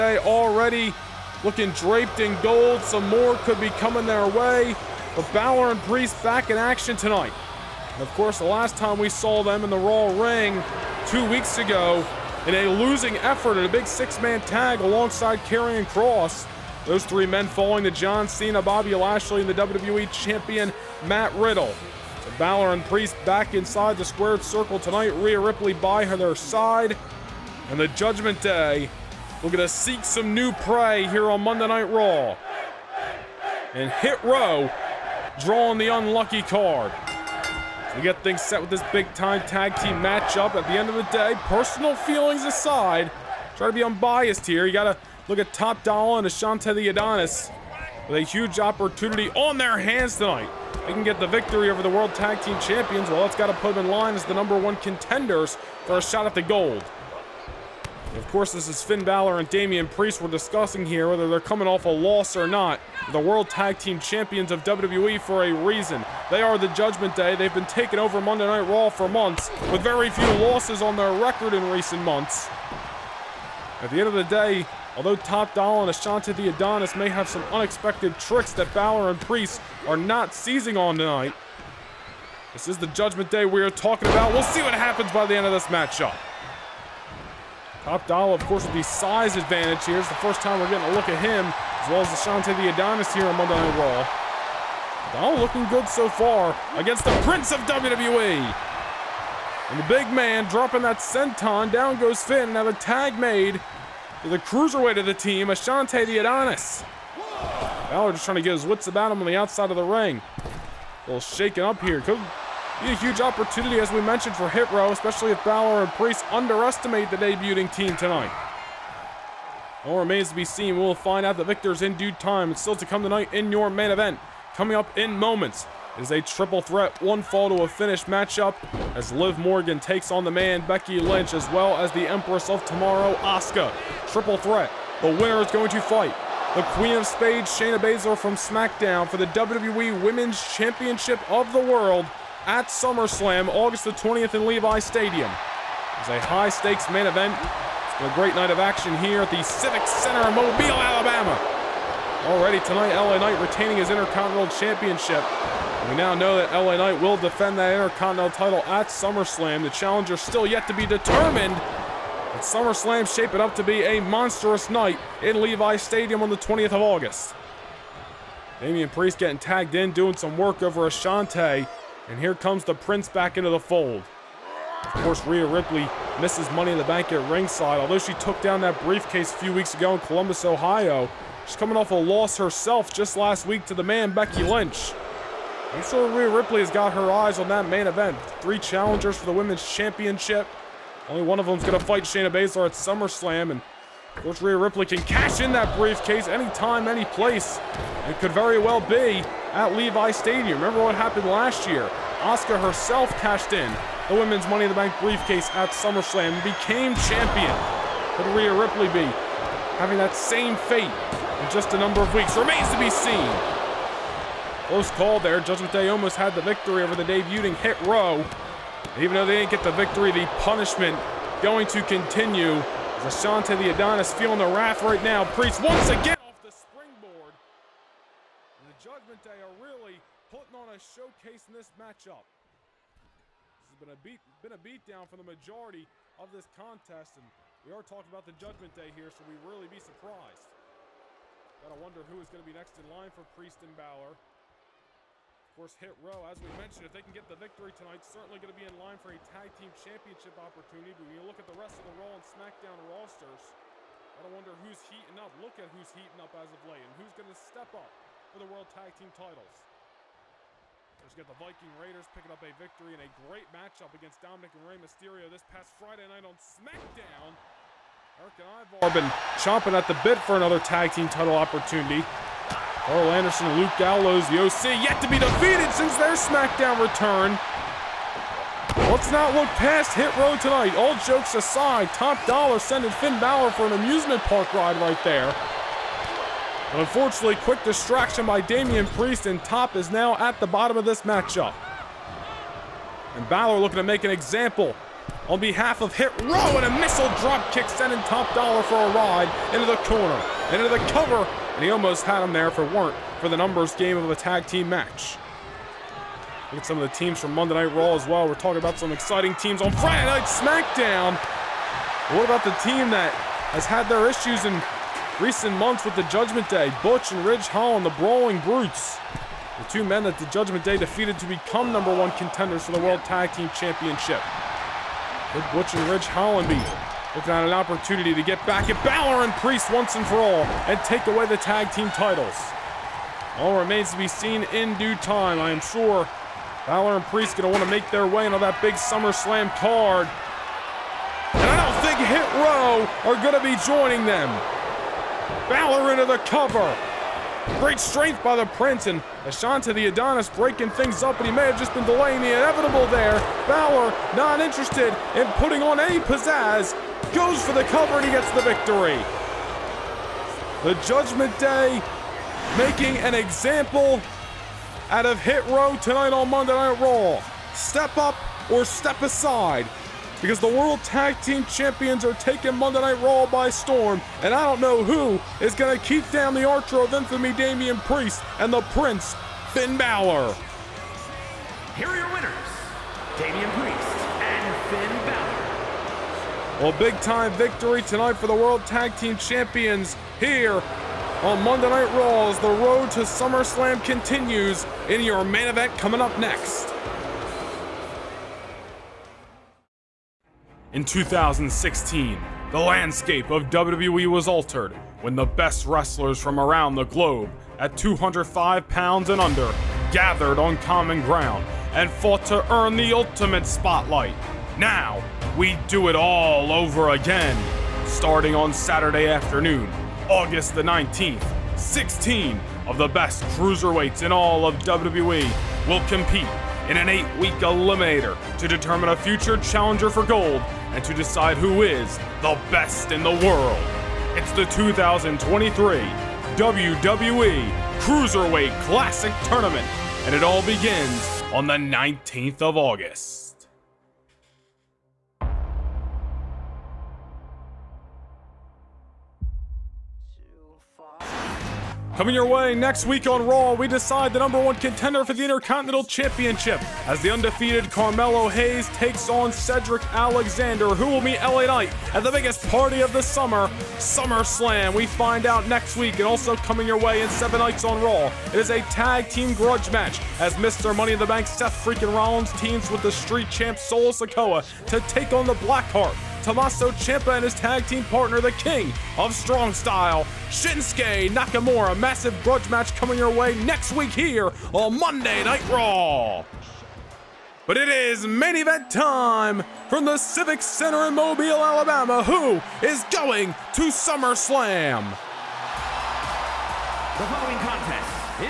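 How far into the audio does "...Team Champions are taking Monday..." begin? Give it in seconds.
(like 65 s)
371 s.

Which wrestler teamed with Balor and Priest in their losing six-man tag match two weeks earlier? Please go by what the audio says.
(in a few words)
Karrion Kross.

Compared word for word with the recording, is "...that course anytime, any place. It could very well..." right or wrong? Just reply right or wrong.
wrong.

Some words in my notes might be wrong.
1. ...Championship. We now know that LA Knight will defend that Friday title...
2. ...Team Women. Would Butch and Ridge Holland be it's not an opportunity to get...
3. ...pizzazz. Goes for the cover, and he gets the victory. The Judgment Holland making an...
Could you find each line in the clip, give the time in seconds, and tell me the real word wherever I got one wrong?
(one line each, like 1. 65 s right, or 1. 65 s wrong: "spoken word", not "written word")
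1. 154 s wrong: "Intercontinental", not "Friday"
2. 323 s wrong: "Championship", not "Women"
3. 355 s wrong: "Day", not "Holland".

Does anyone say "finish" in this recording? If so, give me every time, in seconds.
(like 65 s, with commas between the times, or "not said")
127 s.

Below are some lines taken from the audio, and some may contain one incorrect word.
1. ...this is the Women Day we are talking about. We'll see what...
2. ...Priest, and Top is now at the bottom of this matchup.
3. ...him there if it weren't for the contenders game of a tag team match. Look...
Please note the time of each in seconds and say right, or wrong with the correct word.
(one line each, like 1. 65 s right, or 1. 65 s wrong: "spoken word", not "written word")
1. 82 s wrong: "Judgment", not "Women"
2. 288 s right
3. 302 s wrong: "numbers", not "contenders".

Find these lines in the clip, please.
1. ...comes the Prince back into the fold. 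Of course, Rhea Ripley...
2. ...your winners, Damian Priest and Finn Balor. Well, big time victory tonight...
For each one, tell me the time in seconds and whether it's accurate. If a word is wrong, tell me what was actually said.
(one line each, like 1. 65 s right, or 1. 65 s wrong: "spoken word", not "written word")
1. 172 s right
2. 381 s right.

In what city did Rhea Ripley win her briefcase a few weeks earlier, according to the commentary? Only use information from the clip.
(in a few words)
Columbus, Ohio.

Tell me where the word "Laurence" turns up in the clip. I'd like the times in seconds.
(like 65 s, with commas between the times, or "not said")
not said.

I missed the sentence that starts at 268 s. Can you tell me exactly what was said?
Erik and Ivar been chomping at the bit for another tag team title opportunity.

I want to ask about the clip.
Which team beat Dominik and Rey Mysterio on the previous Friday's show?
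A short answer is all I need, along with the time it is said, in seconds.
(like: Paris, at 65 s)
the Viking Raiders, at 261 s.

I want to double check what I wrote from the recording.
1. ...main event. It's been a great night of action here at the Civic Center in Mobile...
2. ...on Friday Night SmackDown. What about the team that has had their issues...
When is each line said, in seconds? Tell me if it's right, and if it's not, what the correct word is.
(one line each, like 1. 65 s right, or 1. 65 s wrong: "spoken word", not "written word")
1. 146 s right
2. 309 s right.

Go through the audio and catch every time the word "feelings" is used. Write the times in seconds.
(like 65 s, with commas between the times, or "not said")
41 s, 224 s.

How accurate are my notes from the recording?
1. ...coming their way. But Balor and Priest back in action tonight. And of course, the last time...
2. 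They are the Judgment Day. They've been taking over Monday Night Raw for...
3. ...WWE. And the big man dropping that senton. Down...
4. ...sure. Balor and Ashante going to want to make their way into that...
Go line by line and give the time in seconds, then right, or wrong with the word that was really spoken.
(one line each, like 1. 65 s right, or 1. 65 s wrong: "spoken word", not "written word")
1. 3 s right
2. 66 s right
3. 97 s right
4. 335 s wrong: "Priest", not "Ashante".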